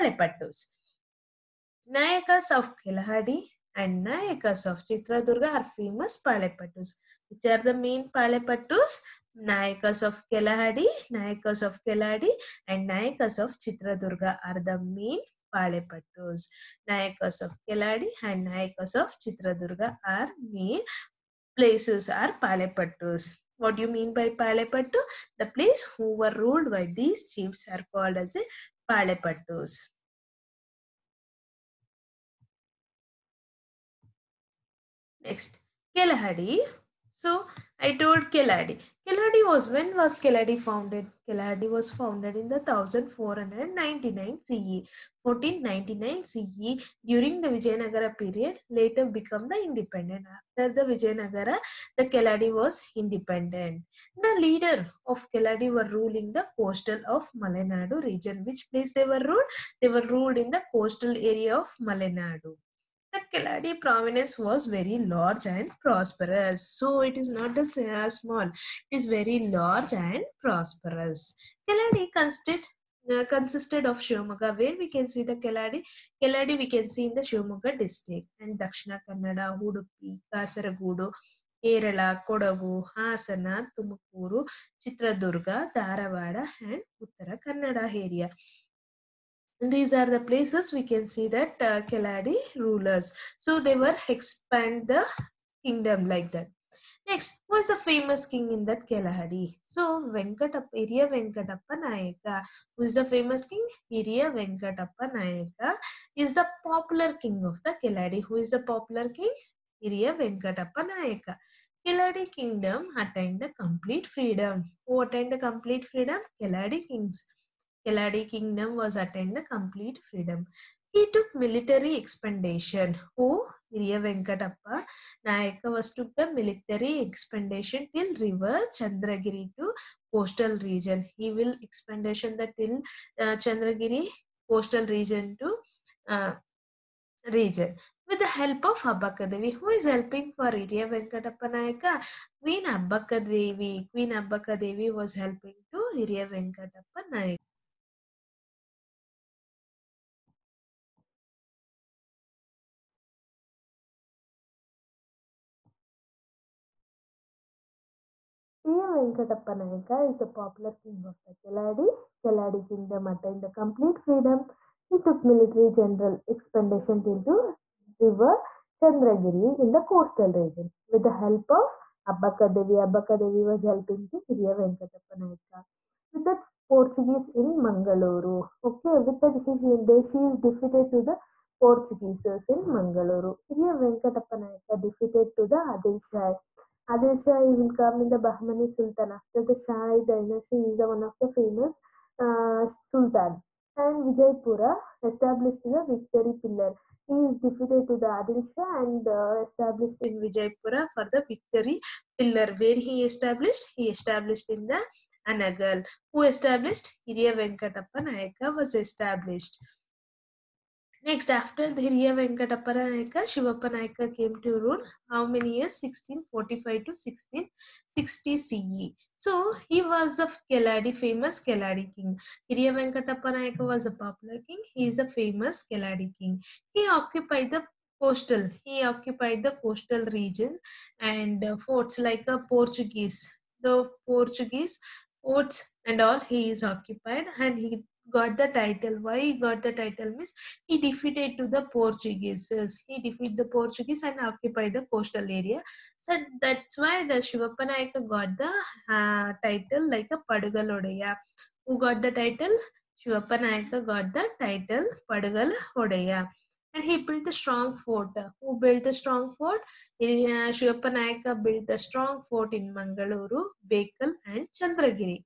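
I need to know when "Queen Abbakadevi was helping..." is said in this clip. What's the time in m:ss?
2:23.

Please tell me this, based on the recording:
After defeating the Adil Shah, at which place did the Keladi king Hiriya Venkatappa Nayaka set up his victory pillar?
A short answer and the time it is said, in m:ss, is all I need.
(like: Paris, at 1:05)
Anagal, at 3:25.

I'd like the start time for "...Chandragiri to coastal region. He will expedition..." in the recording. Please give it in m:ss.
2:08.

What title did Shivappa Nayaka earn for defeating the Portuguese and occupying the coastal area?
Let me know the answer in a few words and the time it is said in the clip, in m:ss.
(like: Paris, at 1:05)
Padugalodaya, at 4:10.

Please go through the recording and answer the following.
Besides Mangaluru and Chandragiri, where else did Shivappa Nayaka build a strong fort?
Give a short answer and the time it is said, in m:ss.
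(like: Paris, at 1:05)
Bekal, at 4:23.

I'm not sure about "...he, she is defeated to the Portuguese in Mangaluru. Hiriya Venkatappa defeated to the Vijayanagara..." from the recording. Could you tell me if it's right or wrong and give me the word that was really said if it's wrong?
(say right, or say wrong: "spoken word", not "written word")
wrong: "Adil", not "Vijayanagara".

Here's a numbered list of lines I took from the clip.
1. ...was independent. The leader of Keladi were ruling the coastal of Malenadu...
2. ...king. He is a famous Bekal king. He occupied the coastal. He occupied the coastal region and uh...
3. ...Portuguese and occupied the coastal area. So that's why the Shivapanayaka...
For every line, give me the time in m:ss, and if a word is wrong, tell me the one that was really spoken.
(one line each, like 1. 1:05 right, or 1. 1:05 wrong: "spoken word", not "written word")
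1. 0:52 right
2. 3:44 wrong: "Keladi", not "Bekal"
3. 4:03 right.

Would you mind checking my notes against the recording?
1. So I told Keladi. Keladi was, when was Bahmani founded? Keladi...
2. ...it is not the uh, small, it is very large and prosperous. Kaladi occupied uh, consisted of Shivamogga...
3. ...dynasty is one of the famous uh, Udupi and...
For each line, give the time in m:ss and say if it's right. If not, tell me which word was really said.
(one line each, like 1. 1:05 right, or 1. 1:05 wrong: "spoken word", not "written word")
1. 0:37 wrong: "Keladi", not "Bahmani"
2. 1:07 wrong: "consisted", not "occupied"
3. 3:10 wrong: "Sultan", not "Udupi".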